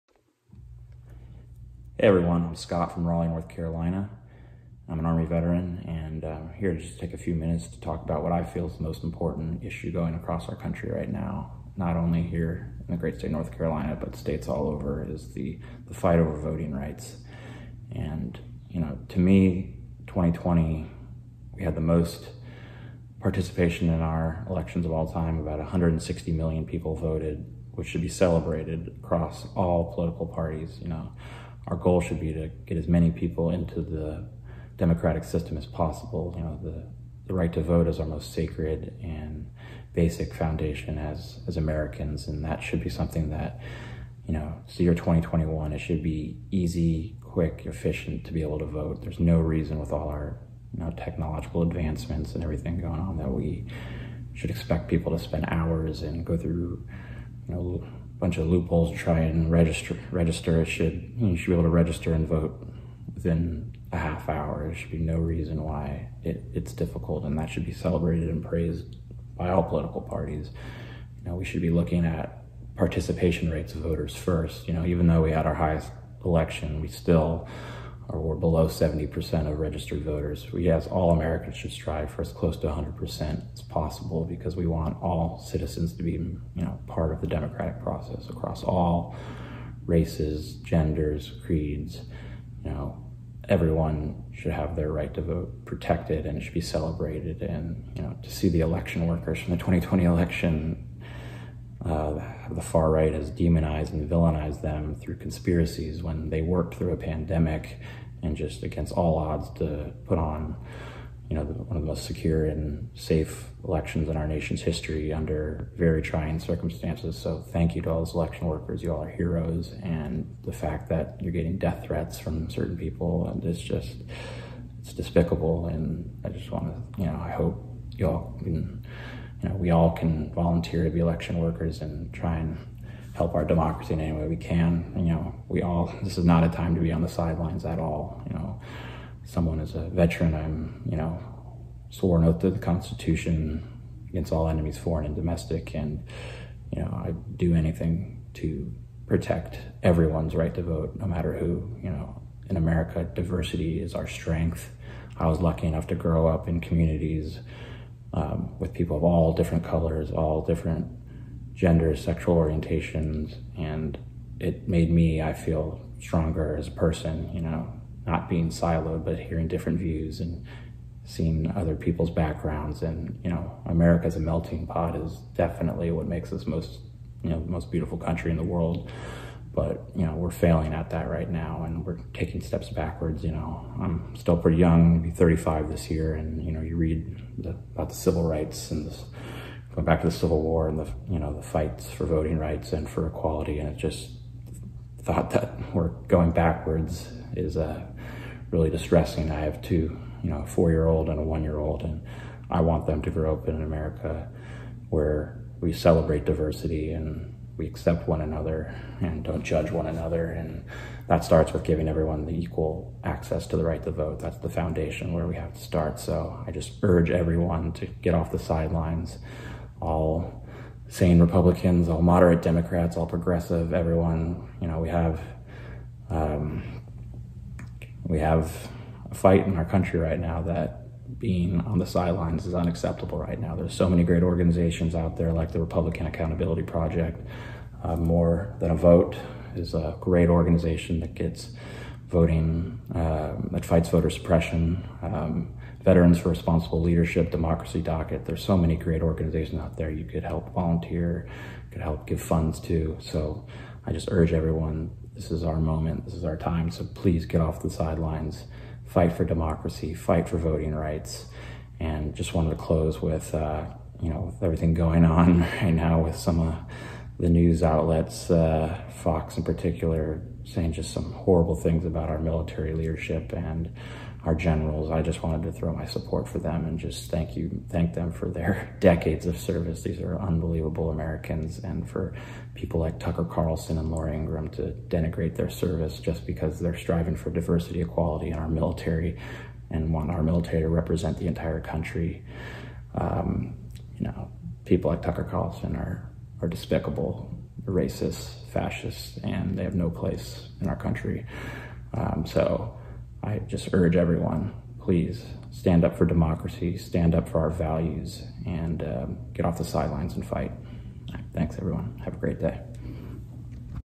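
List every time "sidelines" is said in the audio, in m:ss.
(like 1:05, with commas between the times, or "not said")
2:17, 3:38, 3:51, 4:17, 5:09.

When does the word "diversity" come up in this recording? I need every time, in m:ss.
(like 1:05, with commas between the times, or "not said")
2:33, 3:26, 4:47.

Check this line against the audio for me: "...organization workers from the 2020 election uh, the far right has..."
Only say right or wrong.
wrong.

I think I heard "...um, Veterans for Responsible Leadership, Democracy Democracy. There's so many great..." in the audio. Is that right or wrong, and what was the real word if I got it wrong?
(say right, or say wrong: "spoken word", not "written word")
wrong: "Docket", not "Democracy".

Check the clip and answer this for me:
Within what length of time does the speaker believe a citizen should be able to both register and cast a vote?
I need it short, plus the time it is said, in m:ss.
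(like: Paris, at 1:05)
a half hour, at 1:03.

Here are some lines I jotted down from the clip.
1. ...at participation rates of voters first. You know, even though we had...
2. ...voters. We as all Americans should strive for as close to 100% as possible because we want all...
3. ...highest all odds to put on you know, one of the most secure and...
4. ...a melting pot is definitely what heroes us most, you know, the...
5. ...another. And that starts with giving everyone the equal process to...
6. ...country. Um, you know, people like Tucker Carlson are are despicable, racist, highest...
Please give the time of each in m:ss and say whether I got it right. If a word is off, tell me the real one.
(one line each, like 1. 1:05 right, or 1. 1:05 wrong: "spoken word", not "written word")
1. 1:12 right
2. 1:20 right
3. 1:48 wrong: "against", not "highest"
4. 2:54 wrong: "makes", not "heroes"
5. 3:29 wrong: "access", not "process"
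6. 4:51 wrong: "fascist", not "highest".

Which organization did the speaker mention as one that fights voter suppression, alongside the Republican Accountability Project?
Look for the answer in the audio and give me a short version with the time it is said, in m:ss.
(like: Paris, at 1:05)
More Than a Vote, at 3:57.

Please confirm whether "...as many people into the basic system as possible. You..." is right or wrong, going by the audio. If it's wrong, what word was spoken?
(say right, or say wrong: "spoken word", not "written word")
wrong: "democratic", not "basic".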